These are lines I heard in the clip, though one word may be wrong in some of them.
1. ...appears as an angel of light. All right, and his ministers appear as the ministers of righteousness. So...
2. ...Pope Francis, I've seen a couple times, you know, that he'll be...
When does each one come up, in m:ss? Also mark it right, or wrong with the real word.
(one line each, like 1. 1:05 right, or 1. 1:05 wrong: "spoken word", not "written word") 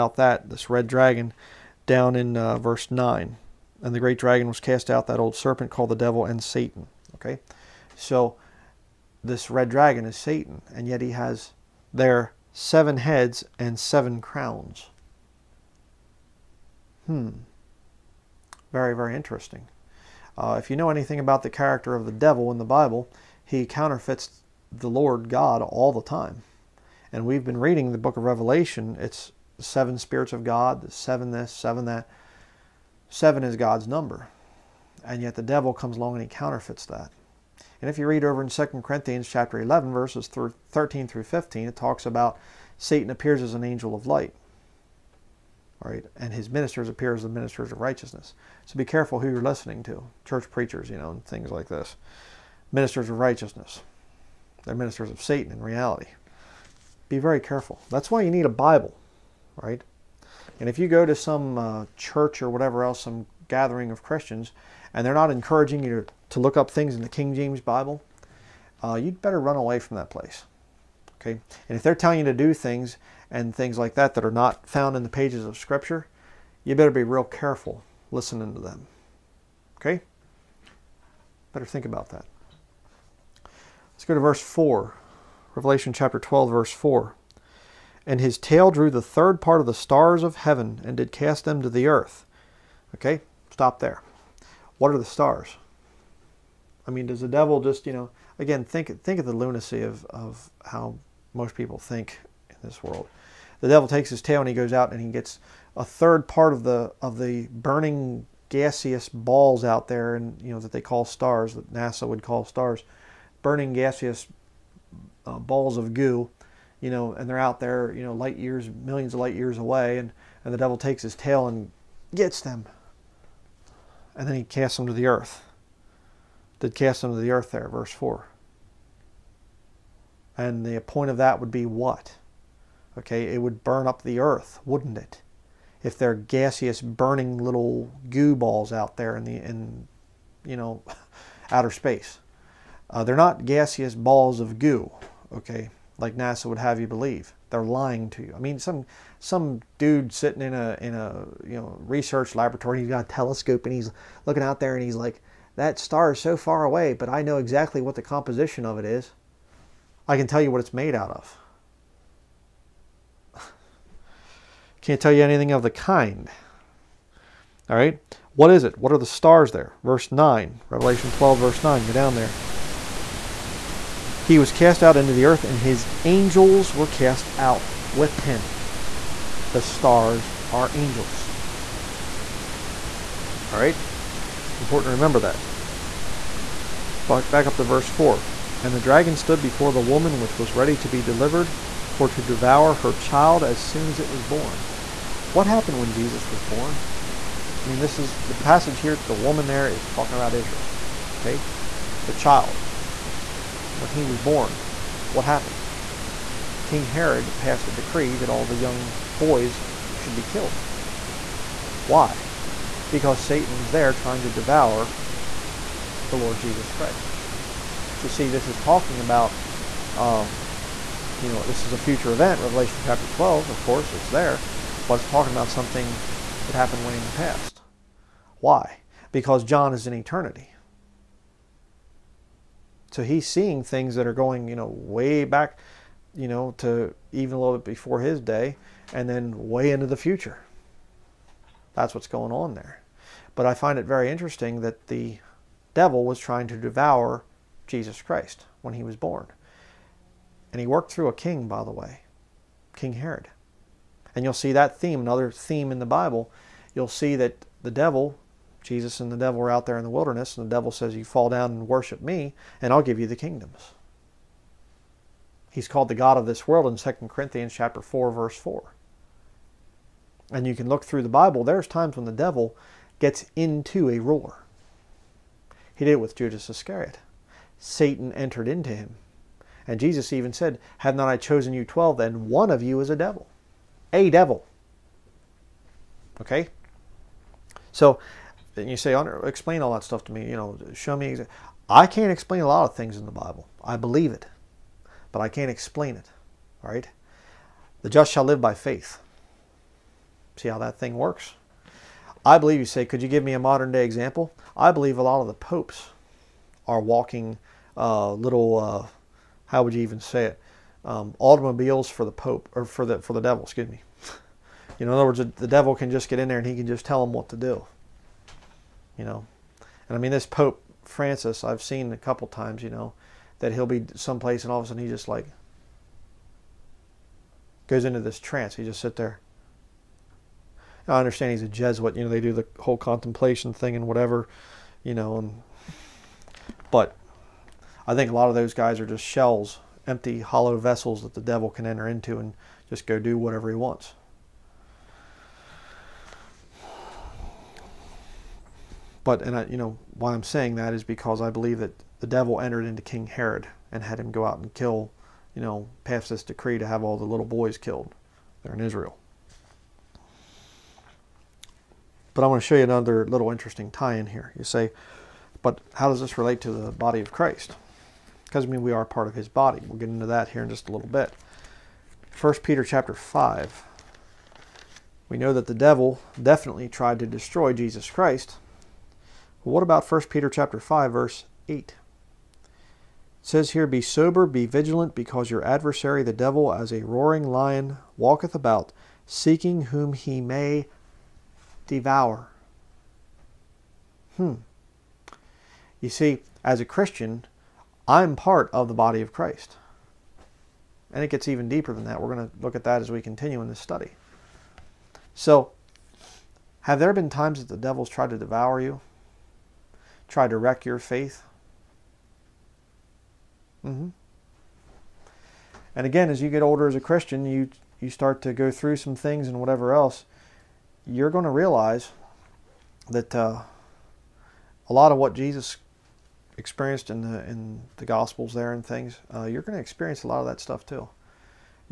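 1. 0:43 right
2. 5:20 right.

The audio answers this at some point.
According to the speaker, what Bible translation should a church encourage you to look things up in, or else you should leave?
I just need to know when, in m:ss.
1:07.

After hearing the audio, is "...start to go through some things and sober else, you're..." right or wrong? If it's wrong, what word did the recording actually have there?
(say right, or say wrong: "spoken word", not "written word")
wrong: "whatever", not "sober".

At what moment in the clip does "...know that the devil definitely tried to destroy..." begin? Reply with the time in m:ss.
6:15.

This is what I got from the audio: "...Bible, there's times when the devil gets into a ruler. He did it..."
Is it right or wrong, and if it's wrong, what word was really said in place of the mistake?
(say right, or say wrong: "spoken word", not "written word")
right.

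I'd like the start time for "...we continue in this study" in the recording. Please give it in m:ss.
6:42.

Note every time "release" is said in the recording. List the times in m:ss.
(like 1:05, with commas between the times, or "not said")
not said.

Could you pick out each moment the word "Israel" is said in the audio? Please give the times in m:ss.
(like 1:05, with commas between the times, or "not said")
3:20, 5:58.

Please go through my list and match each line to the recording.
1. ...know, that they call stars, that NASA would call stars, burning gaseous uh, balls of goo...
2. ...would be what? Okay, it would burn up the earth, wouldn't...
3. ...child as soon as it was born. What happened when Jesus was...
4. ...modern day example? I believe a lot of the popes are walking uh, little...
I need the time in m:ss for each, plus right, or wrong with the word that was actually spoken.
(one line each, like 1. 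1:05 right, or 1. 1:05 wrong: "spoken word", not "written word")
1. 1:50 right
2. 2:11 right
3. 3:12 right
4. 5:03 right.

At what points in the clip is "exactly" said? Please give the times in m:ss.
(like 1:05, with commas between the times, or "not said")
2:37.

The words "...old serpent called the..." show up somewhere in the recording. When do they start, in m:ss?
0:05.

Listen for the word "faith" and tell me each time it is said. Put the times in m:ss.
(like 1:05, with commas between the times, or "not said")
4:58, 6:50.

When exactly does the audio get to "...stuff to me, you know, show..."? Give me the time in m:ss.
4:49.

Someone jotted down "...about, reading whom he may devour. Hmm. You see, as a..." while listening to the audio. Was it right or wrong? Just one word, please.
wrong.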